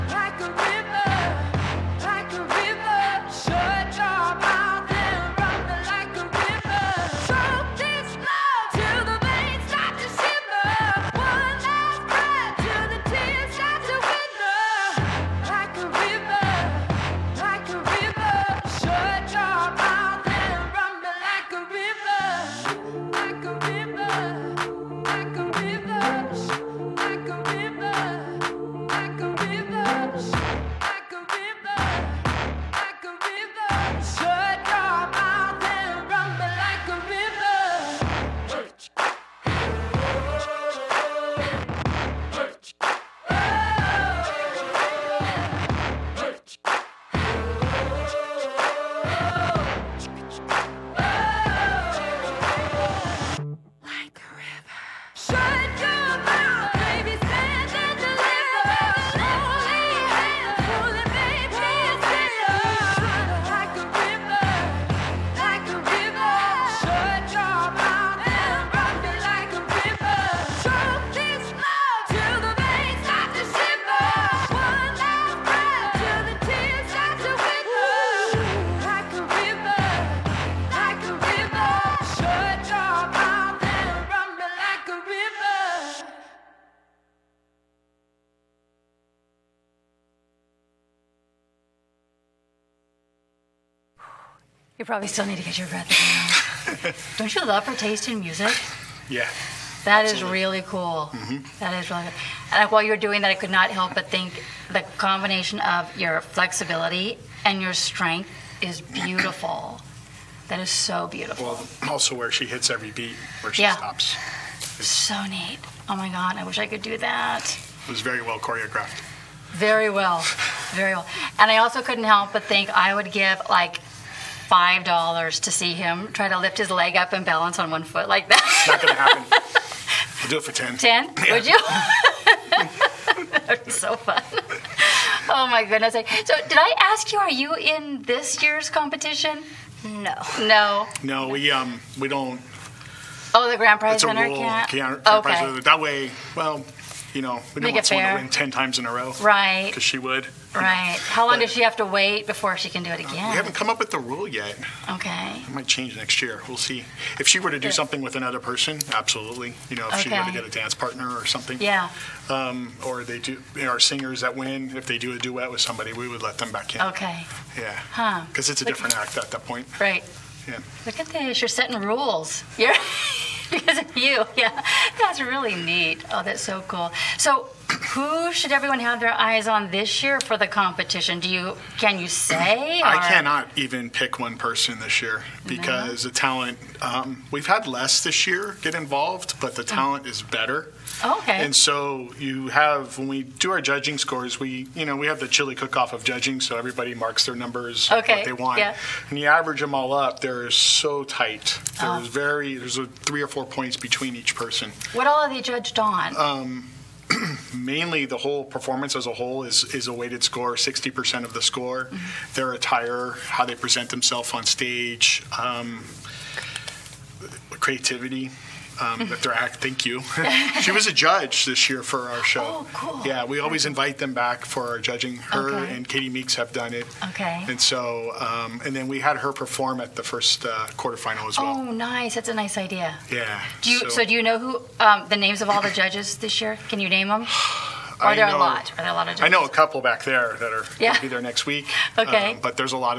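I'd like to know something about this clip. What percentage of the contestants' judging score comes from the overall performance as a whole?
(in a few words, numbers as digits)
60%.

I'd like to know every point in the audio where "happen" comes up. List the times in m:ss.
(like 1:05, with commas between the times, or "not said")
2:08.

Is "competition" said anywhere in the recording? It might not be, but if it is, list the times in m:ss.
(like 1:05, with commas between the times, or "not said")
2:18, 3:00.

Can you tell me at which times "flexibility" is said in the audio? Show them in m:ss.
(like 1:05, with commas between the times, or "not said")
1:46.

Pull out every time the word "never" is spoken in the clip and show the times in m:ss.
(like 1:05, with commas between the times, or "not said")
not said.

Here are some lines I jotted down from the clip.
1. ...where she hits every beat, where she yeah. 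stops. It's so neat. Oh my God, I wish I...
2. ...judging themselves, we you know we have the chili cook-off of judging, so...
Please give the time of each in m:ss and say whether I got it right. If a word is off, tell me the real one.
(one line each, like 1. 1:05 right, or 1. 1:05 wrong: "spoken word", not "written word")
1. 1:52 right
2. 3:13 wrong: "scores", not "themselves".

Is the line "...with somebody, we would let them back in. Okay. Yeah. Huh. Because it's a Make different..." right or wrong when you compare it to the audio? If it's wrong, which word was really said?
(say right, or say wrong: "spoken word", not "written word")
wrong: "Look", not "Make".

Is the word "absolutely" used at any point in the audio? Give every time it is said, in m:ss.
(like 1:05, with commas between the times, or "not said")
1:40, 2:38.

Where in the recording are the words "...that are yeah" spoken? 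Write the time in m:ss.
4:00.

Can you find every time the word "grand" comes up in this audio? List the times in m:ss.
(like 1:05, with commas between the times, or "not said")
2:23.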